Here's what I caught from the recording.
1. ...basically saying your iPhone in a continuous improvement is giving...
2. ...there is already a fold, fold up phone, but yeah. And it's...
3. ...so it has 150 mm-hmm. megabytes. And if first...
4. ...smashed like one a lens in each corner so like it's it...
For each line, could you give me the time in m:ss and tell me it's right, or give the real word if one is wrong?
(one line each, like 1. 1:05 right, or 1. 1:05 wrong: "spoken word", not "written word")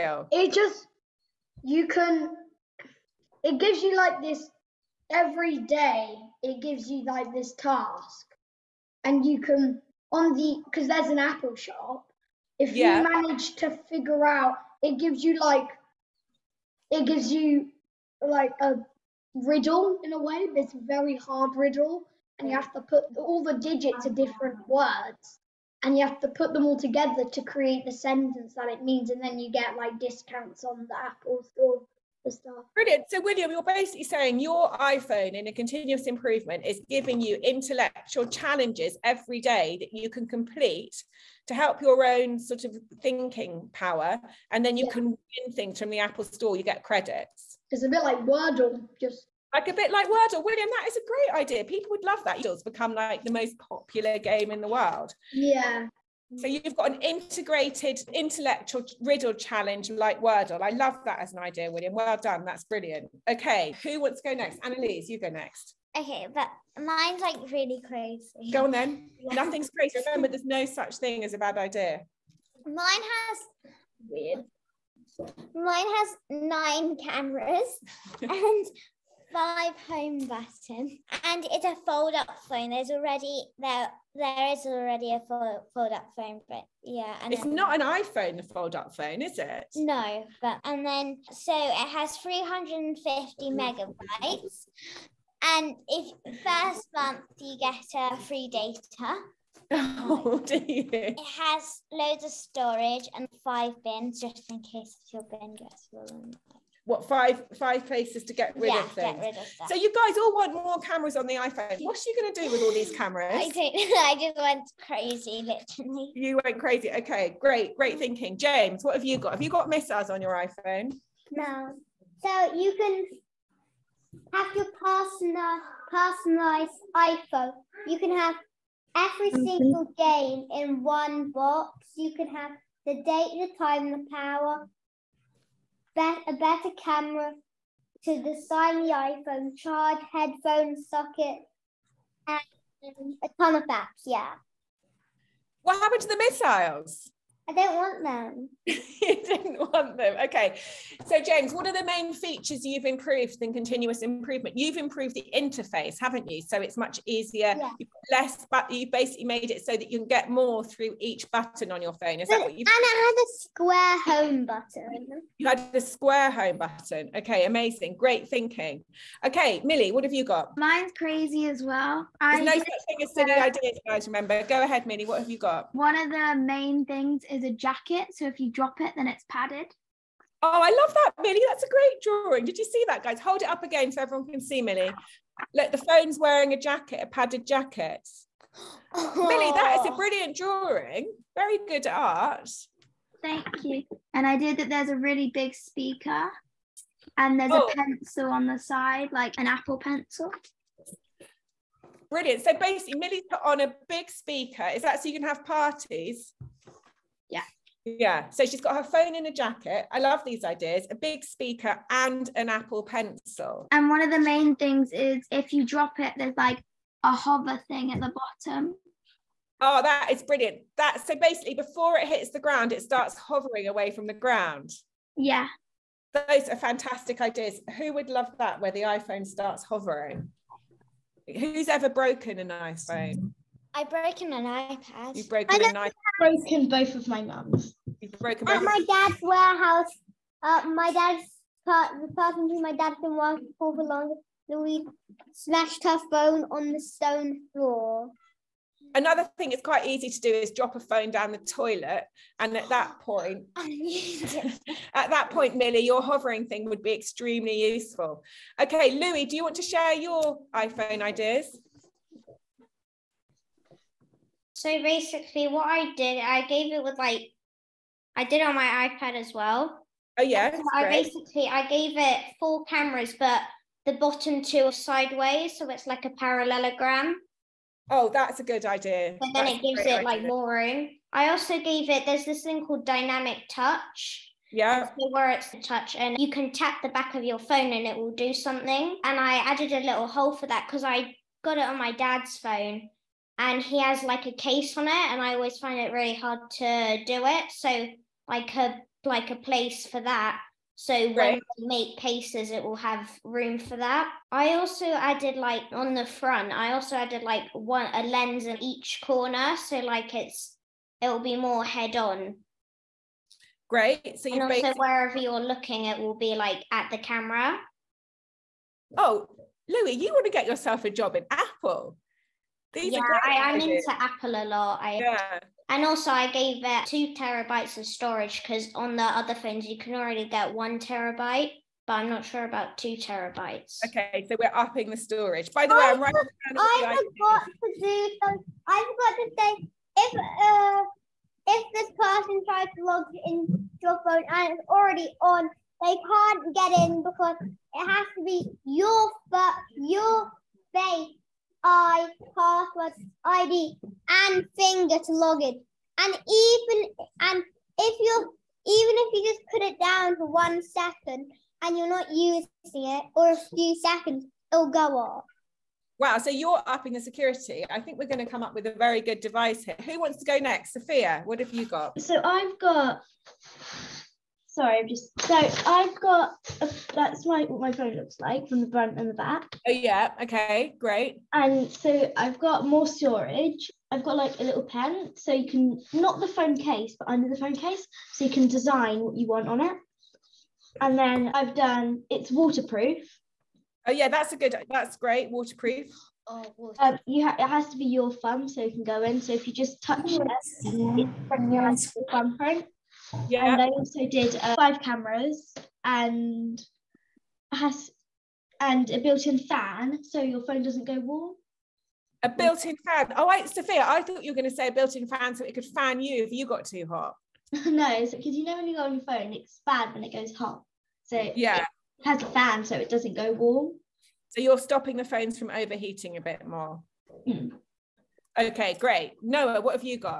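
1. 0:33 right
2. 1:24 right
3. 1:31 wrong: "350", not "150"
4. 5:06 wrong: "added", not "smashed".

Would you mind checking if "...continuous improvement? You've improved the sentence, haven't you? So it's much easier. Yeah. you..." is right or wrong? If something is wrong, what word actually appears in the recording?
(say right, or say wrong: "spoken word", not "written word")
wrong: "interface", not "sentence".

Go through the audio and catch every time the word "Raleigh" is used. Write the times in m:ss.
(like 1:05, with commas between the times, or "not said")
not said.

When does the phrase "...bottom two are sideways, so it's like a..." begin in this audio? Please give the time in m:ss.
4:33.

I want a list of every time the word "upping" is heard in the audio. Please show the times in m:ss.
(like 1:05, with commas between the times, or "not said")
5:34, 6:06.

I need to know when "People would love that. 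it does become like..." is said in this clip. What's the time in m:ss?
0:51.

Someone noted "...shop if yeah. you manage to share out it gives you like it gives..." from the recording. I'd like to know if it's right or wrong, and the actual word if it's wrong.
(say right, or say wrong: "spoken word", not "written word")
wrong: "figure", not "share".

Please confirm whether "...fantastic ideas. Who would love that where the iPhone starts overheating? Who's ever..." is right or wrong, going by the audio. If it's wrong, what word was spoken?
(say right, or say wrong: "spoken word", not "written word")
wrong: "hovering", not "overheating".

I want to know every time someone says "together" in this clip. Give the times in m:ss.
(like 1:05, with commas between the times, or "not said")
0:26.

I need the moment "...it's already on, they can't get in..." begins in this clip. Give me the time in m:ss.
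5:44.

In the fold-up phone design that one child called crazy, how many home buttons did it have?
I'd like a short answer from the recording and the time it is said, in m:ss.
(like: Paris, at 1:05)
5, at 1:19.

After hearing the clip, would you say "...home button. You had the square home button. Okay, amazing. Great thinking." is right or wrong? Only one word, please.
right.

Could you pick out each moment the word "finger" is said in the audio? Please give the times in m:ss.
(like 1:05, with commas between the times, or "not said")
5:54.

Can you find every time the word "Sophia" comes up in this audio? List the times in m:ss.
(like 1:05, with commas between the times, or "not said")
6:10, 6:53.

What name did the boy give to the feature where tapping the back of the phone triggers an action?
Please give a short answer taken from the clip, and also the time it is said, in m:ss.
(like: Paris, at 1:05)
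Dynamic touch, at 4:42.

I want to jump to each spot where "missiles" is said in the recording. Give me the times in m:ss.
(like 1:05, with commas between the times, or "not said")
1:59, 2:26.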